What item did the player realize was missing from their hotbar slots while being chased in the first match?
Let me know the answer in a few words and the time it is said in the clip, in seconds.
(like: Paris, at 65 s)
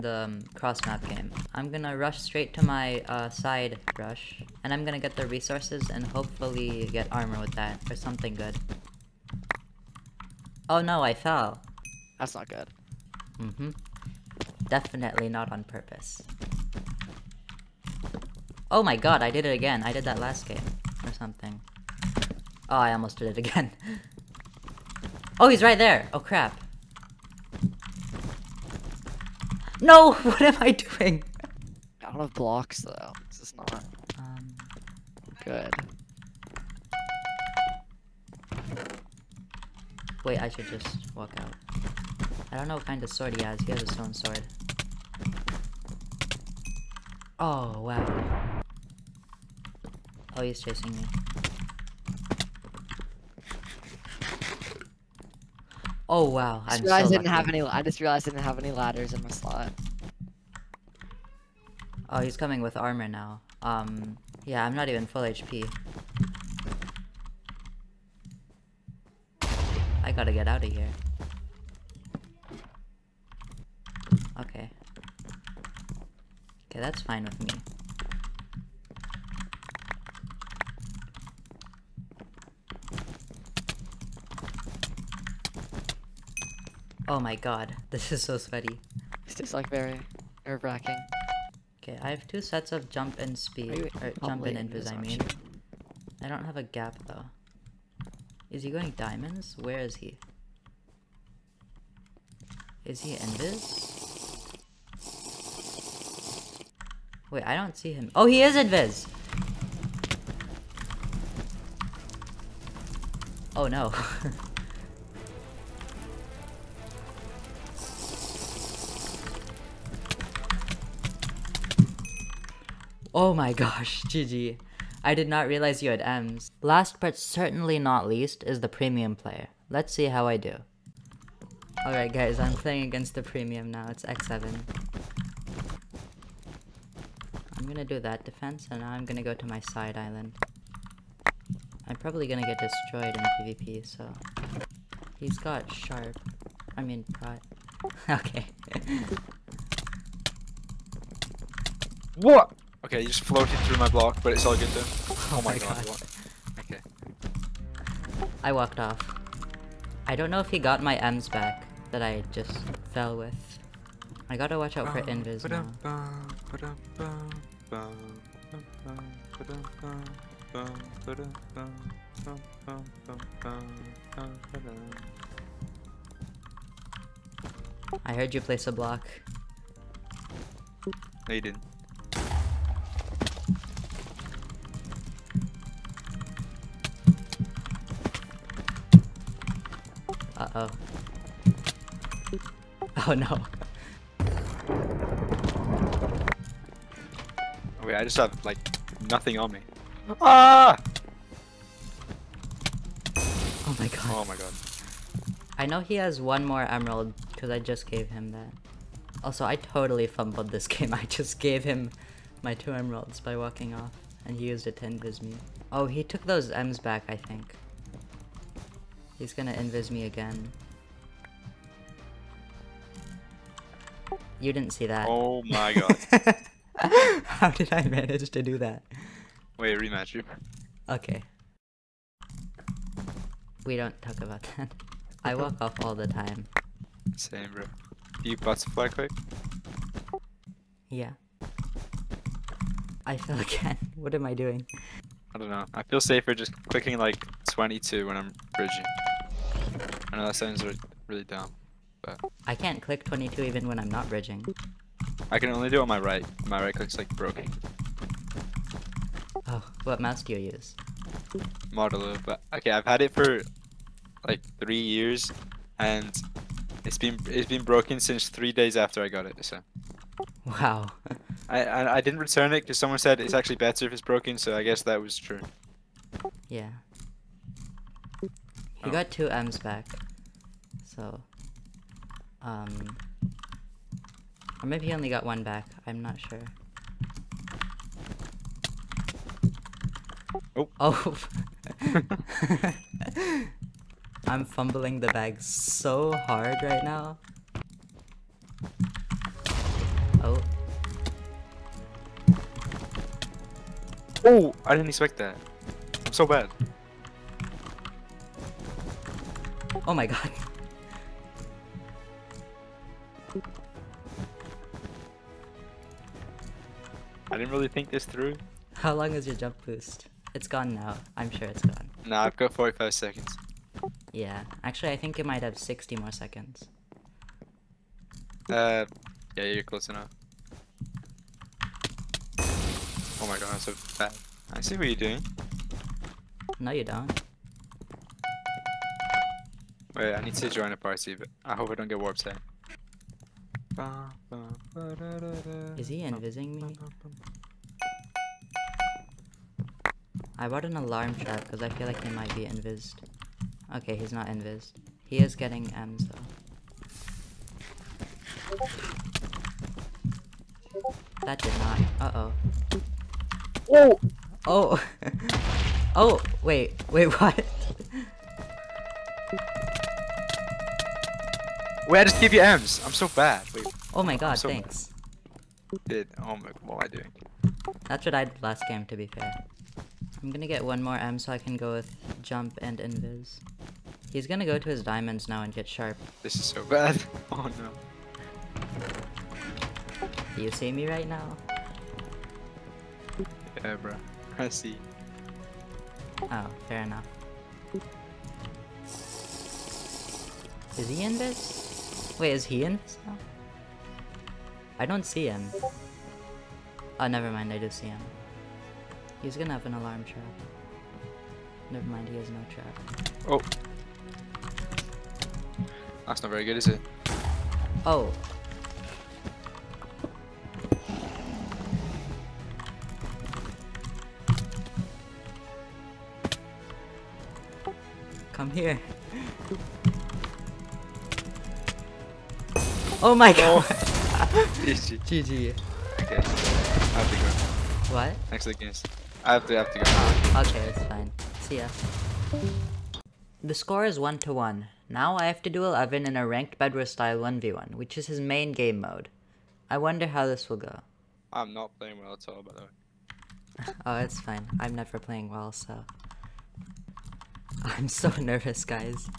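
Ladders, at 58 s.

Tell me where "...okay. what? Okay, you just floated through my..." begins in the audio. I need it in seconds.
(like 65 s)
148 s.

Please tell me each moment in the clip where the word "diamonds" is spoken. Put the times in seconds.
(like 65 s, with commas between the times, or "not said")
98 s, 384 s.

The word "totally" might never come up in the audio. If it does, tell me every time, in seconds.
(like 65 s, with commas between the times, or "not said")
209 s.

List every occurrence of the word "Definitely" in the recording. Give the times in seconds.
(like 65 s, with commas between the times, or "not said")
14 s.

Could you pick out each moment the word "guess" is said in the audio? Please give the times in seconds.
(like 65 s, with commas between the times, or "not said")
274 s.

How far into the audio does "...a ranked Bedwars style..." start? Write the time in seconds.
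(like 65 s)
446 s.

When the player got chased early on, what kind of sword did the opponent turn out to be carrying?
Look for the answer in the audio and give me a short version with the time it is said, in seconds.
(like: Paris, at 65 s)
Stone sword, at 43 s.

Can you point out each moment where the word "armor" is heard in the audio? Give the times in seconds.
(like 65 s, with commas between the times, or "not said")
7 s, 62 s.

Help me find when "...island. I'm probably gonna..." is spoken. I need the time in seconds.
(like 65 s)
139 s.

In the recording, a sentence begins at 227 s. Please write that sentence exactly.
How did I manage to do that?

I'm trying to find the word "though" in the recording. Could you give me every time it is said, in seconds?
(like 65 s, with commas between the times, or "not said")
32 s, 97 s, 356 s.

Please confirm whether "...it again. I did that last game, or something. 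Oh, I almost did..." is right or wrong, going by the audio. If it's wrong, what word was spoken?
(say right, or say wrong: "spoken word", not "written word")
right.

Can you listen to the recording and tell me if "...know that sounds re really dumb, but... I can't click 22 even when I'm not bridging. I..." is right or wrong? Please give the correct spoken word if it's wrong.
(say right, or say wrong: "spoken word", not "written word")
right.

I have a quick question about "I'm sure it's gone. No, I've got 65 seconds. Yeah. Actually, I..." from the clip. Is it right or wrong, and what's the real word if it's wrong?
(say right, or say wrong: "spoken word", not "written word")
wrong: "45", not "65".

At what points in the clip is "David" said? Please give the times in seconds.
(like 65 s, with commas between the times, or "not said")
not said.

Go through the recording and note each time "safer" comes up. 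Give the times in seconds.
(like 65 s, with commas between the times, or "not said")
245 s.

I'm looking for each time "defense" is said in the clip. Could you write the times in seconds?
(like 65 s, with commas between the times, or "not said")
138 s.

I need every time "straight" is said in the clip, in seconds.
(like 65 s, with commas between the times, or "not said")
2 s.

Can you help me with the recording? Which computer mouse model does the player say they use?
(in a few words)
Model O.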